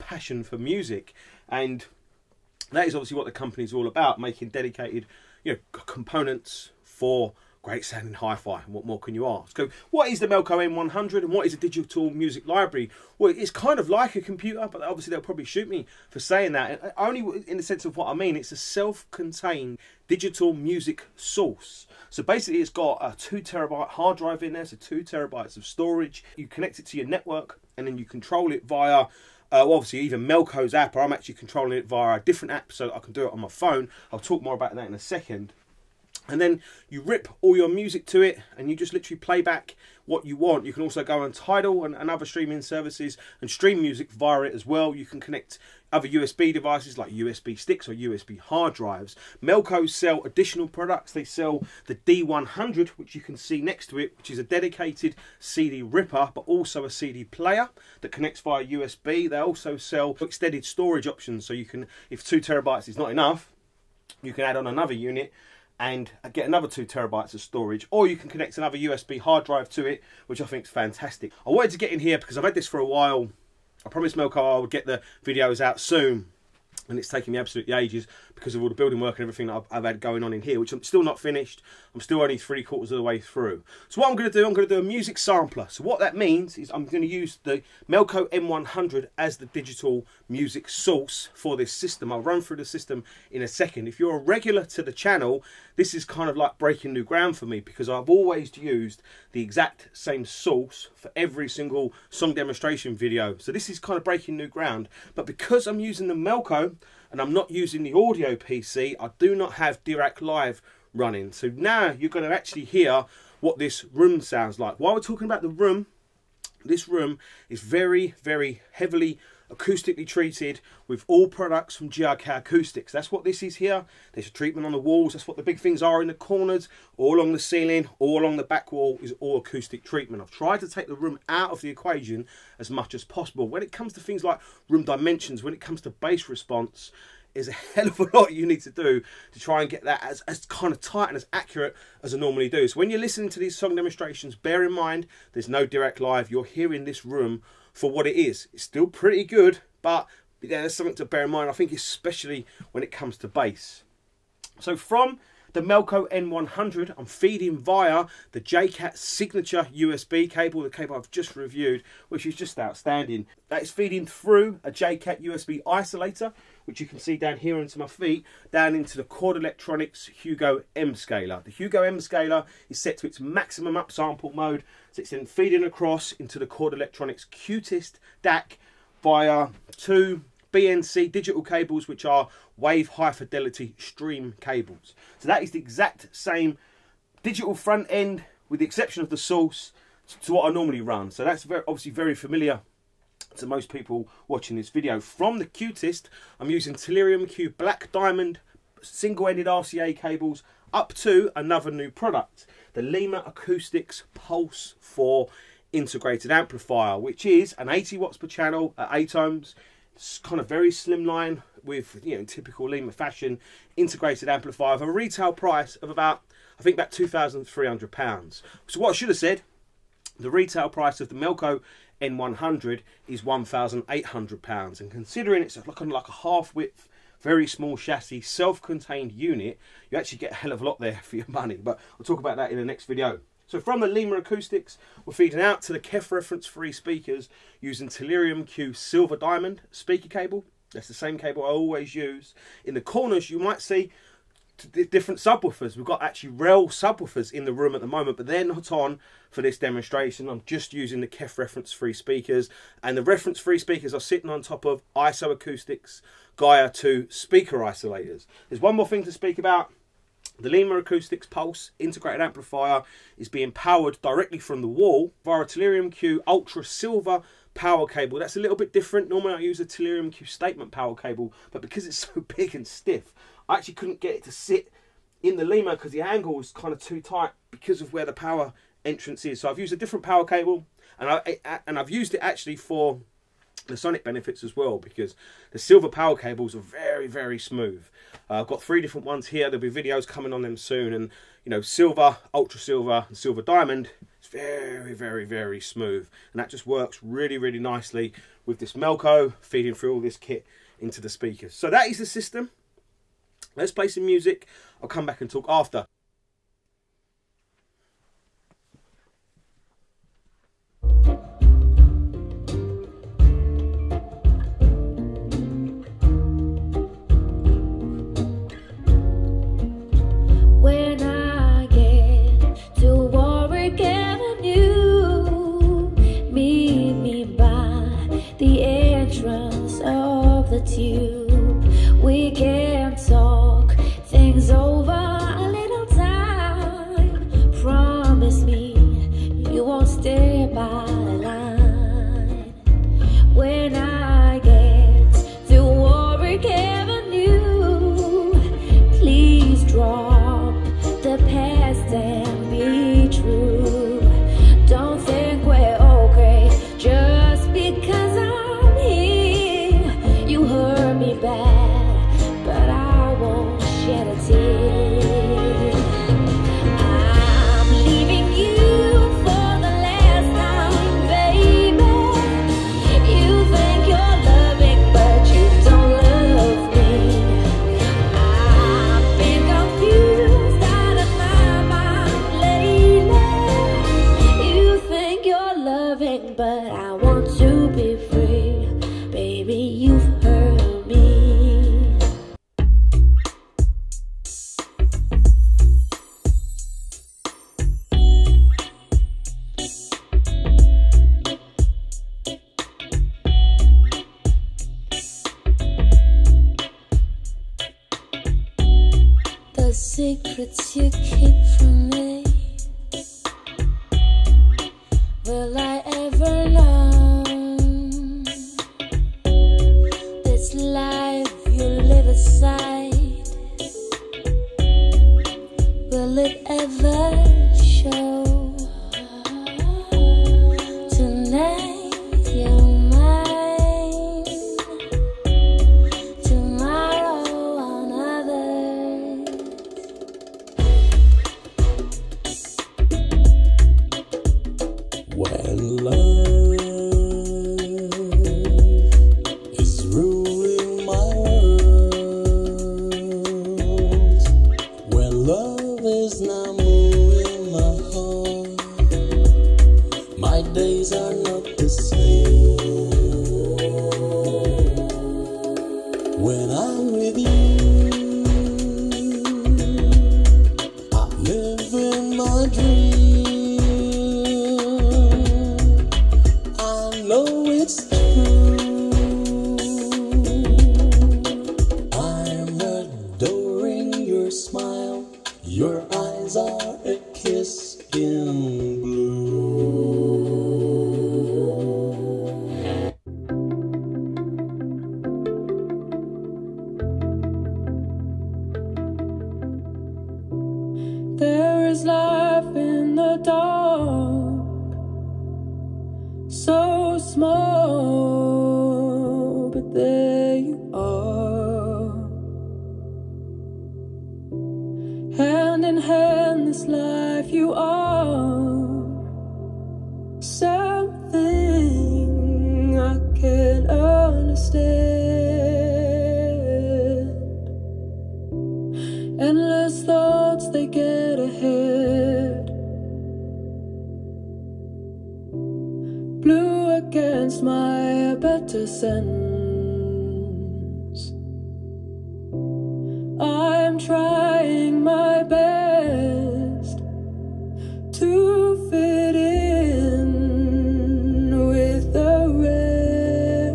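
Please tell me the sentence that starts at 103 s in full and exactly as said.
So this is kind of breaking new ground.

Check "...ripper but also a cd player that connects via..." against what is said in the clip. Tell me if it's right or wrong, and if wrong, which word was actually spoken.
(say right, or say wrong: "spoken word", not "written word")
right.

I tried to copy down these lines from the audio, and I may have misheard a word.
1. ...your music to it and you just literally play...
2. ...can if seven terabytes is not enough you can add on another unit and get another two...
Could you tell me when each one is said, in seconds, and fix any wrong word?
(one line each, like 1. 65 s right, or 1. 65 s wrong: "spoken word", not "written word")
1. 37 s right
2. 61 s wrong: "two", not "seven".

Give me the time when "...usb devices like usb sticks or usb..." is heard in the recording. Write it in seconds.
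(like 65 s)
46 s.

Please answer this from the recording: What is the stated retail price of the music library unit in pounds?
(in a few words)
£1,800.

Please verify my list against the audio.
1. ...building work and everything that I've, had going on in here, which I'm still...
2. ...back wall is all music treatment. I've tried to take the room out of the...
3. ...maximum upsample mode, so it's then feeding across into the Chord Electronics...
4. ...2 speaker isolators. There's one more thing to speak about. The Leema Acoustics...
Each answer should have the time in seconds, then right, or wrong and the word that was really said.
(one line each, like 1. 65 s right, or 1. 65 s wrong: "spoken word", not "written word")
1. 78 s right
2. 128 s wrong: "acoustic", not "music"
3. 173 s right
4. 256 s right.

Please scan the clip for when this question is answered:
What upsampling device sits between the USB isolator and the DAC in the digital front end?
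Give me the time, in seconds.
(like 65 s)
169 s.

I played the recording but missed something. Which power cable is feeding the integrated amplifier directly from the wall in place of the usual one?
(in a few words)
Tellurium Q Ultra Silver.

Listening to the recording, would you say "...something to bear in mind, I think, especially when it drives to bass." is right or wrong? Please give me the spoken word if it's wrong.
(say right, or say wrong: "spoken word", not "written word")
wrong: "comes", not "drives".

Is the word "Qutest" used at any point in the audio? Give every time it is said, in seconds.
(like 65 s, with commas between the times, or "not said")
177 s, 195 s.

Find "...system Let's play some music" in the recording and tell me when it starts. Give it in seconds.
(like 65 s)
302 s.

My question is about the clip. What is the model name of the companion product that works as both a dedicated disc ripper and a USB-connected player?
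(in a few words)
D100.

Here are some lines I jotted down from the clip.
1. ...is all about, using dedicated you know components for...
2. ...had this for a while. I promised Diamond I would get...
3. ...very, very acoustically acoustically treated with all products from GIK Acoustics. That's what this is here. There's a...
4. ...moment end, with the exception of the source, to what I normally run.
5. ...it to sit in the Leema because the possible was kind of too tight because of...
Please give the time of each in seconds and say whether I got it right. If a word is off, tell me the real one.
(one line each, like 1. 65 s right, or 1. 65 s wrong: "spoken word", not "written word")
1. 3 s wrong: "making", not "using"
2. 72 s wrong: "Melco", not "Diamond"
3. 117 s wrong: "heavily", not "acoustically"
4. 187 s wrong: "front", not "moment"
5. 274 s wrong: "angle", not "possible".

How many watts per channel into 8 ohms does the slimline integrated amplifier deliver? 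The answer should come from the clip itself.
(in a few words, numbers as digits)
80 watts.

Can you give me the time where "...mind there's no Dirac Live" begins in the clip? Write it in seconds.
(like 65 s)
144 s.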